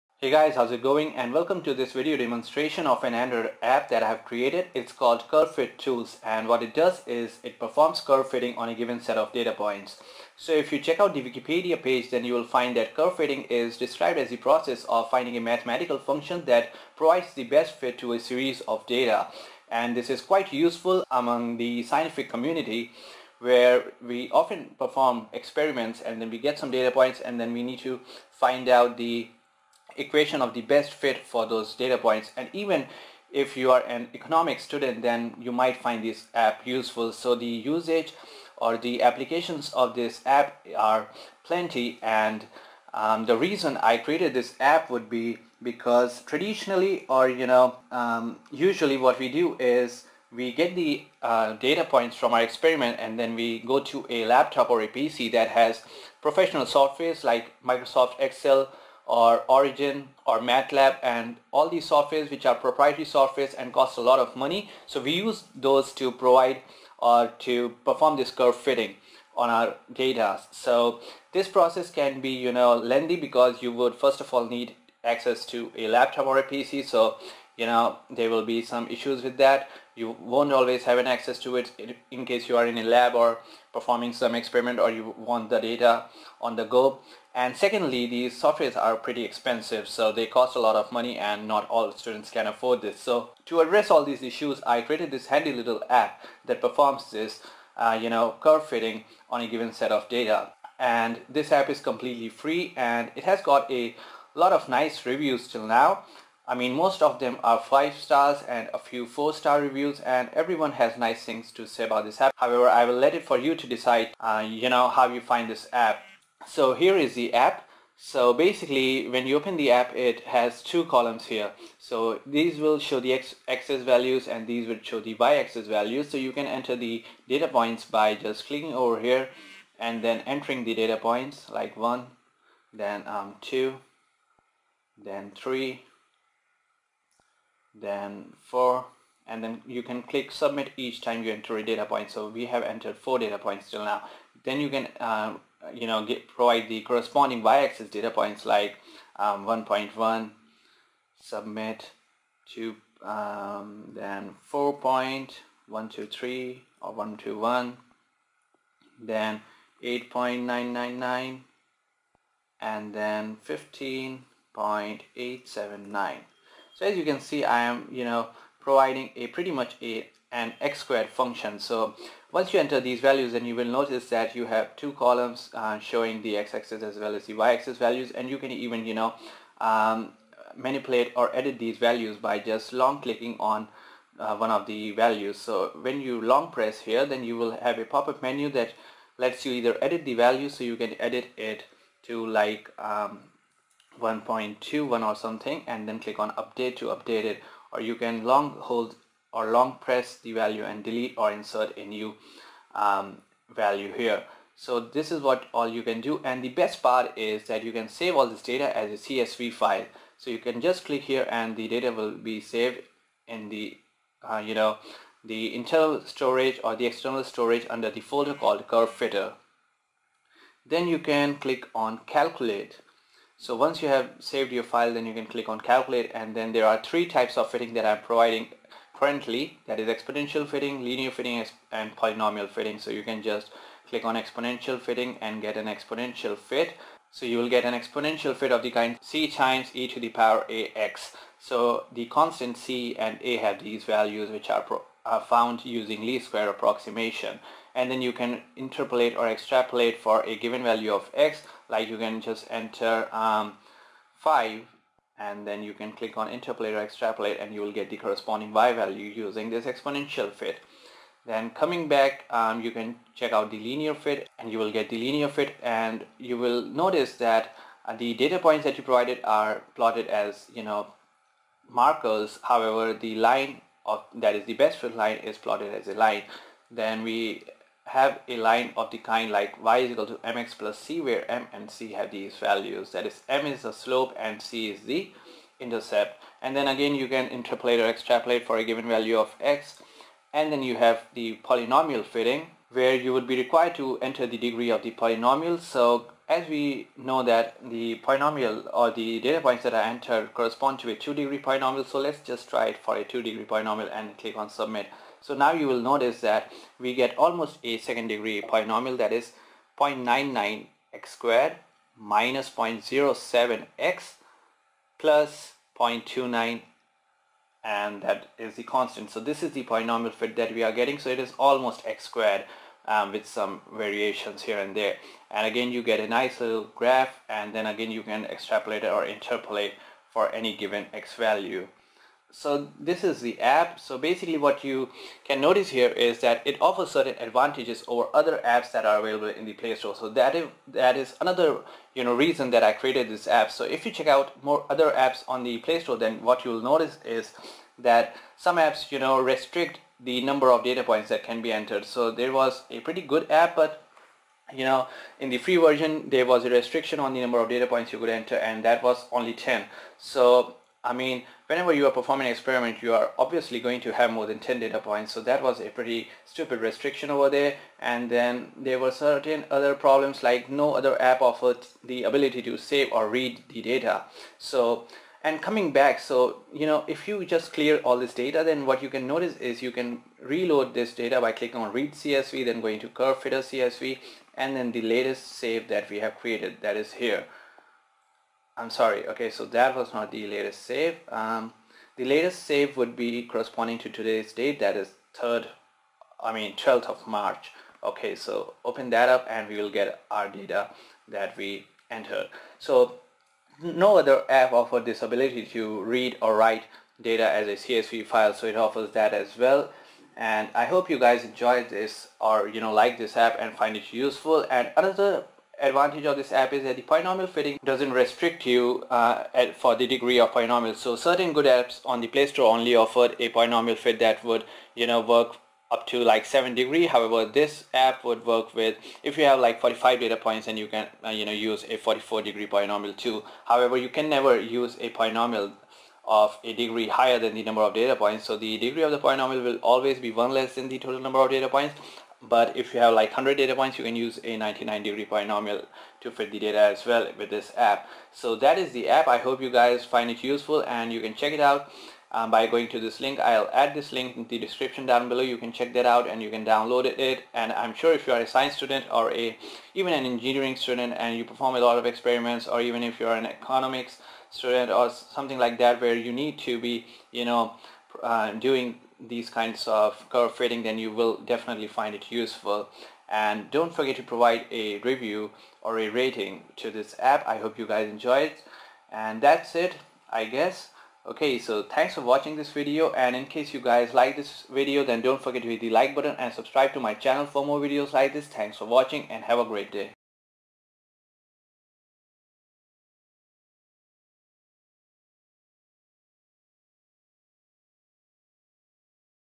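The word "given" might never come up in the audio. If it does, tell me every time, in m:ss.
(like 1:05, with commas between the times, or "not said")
0:08, 1:39, 4:10, 4:48, 5:30.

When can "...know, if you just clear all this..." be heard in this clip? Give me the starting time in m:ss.
6:16.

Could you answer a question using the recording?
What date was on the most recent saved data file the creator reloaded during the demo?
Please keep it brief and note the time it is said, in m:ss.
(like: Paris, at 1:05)
12th of March, at 6:36.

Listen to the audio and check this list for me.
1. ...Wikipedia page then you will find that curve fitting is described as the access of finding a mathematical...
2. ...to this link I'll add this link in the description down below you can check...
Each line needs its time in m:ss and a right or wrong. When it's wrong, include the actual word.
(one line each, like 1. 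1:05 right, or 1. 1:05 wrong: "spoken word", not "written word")
1. 0:11 wrong: "process", not "access"
2. 7:32 right.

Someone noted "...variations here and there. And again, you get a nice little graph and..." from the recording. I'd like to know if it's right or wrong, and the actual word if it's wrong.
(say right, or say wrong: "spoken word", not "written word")
right.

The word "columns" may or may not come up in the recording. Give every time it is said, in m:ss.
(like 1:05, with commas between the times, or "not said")
2:00, 2:54.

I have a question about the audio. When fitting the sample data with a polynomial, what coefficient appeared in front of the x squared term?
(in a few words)
0.99.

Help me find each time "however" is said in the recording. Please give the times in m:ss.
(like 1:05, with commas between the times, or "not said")
1:52, 4:32, 7:06, 7:13.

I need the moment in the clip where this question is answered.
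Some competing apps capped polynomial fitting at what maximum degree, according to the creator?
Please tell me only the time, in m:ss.
7:06.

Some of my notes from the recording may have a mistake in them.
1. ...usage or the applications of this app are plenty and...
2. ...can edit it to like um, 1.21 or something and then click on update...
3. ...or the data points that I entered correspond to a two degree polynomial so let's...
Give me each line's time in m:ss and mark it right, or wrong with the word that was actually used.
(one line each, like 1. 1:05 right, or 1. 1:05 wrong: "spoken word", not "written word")
1. 0:37 right
2. 3:10 right
3. 4:58 right.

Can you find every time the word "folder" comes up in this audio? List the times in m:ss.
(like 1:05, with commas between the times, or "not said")
3:38.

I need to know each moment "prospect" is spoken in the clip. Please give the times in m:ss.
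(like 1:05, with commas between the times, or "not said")
not said.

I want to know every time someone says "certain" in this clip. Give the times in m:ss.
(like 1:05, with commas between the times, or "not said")
5:36, 6:08, 7:00.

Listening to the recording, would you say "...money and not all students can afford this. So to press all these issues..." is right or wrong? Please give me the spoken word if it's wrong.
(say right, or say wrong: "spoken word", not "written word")
wrong: "address", not "press".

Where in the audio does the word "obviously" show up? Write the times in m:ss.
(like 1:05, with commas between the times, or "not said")
6:03.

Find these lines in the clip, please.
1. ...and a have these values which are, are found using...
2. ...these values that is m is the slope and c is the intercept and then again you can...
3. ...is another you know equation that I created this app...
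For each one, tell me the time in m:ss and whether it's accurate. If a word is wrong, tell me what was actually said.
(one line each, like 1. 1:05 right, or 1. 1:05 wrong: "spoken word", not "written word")
1. 4:03 right
2. 4:42 right
3. 5:40 wrong: "reason", not "equation".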